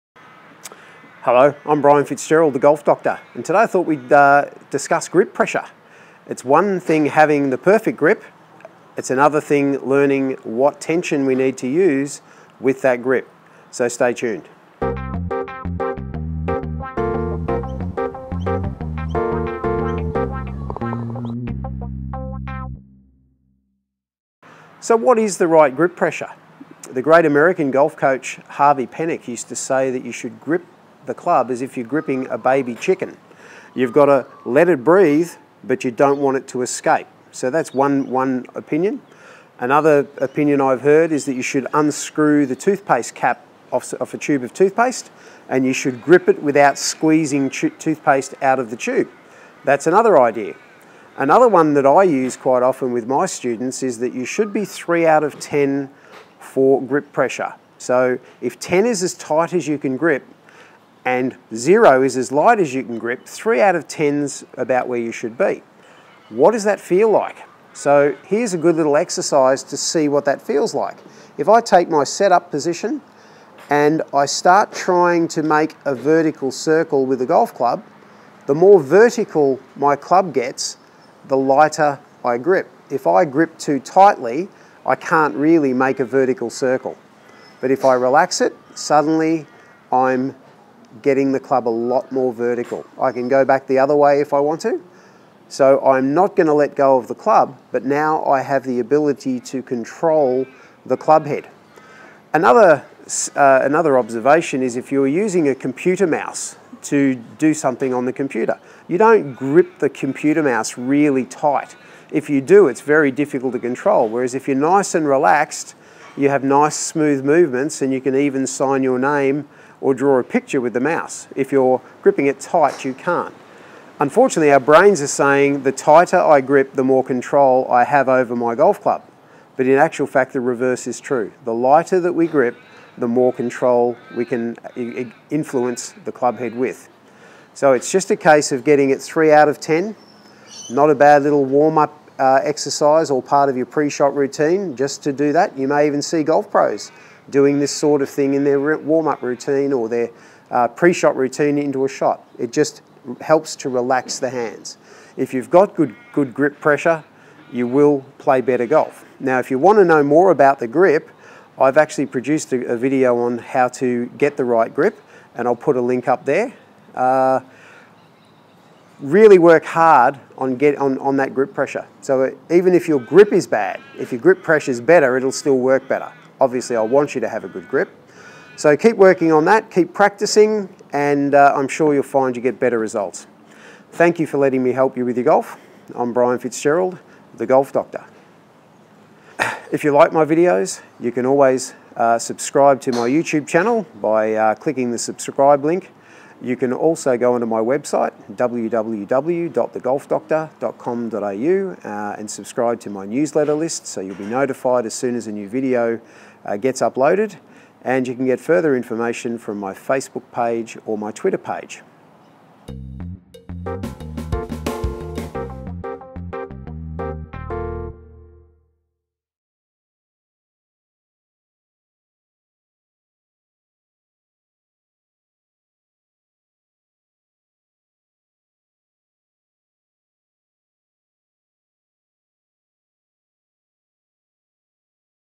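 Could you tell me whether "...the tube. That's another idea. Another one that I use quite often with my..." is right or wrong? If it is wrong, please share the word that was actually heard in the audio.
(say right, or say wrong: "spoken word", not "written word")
right.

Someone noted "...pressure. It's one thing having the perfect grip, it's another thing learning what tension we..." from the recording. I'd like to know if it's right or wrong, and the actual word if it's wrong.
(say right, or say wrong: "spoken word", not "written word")
right.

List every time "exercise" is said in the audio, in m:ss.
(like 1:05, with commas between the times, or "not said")
1:08, 2:22.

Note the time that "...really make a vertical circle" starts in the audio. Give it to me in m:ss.
1:25.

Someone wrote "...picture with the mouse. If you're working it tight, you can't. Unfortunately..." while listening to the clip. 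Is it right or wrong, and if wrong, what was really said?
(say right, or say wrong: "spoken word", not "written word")
wrong: "gripping", not "working".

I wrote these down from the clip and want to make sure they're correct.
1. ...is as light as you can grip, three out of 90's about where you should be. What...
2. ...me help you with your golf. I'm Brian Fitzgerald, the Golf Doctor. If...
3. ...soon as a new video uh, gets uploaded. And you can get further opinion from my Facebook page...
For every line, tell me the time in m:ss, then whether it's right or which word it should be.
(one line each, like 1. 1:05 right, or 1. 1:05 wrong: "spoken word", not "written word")
1. 1:02 wrong: "10", not "90"
2. 3:04 right
3. 3:24 wrong: "information", not "opinion".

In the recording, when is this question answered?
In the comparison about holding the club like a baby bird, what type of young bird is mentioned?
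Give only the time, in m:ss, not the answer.
0:32.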